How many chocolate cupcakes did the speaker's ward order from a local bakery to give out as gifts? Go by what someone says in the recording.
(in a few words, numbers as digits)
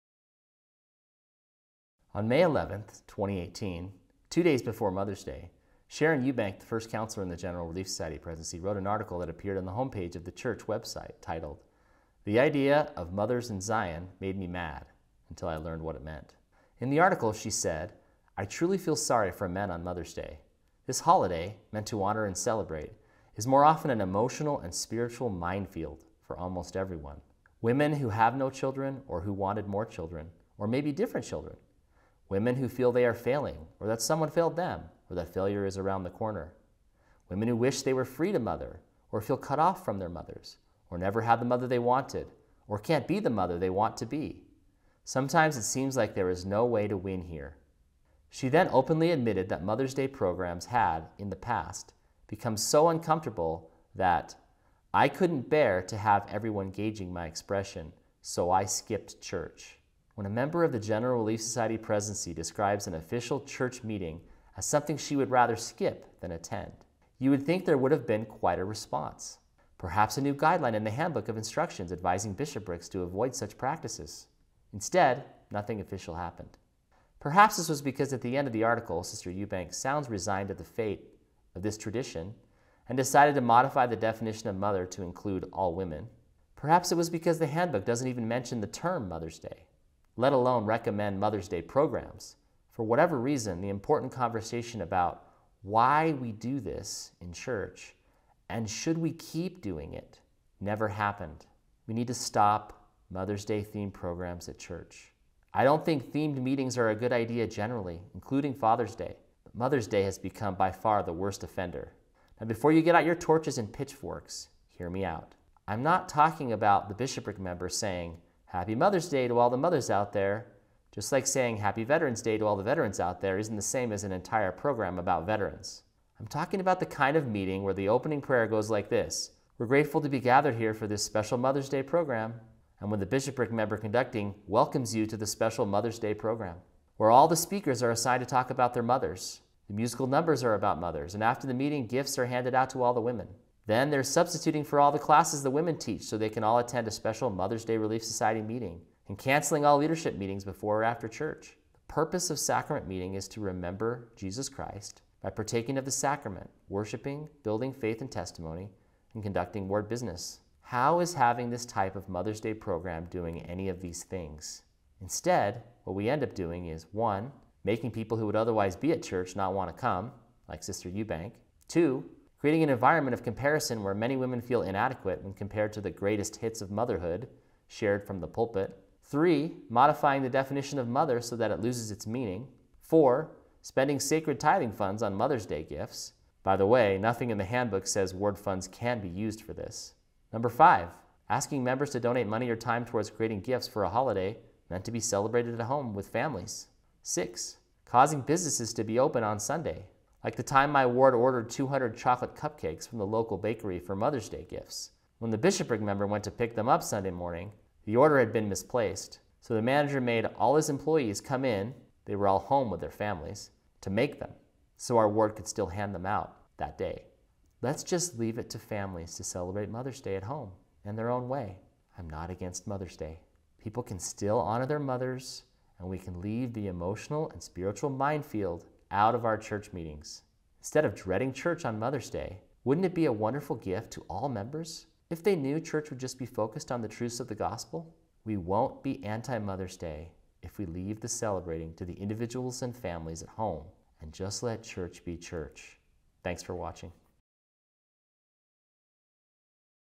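200.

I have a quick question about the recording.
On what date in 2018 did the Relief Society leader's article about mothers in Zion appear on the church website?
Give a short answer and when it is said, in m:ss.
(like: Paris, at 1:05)
May 11th, at 0:02.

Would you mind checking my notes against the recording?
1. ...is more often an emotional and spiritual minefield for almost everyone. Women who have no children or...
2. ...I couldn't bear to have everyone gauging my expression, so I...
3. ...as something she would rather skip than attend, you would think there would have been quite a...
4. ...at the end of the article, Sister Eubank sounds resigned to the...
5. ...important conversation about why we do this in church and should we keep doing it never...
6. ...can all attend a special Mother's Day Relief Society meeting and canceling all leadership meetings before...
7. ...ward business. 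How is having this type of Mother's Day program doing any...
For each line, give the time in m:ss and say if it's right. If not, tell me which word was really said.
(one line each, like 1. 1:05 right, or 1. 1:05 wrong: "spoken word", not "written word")
1. 0:23 right
2. 0:54 right
3. 1:04 right
4. 1:18 right
5. 1:33 right
6. 2:26 right
7. 2:39 right.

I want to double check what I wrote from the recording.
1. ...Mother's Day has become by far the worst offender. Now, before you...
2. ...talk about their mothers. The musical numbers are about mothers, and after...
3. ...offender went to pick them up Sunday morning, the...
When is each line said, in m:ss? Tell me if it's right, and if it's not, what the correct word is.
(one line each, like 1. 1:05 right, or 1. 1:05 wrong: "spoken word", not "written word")
1. 1:49 right
2. 2:18 right
3. 3:25 wrong: "member", not "offender".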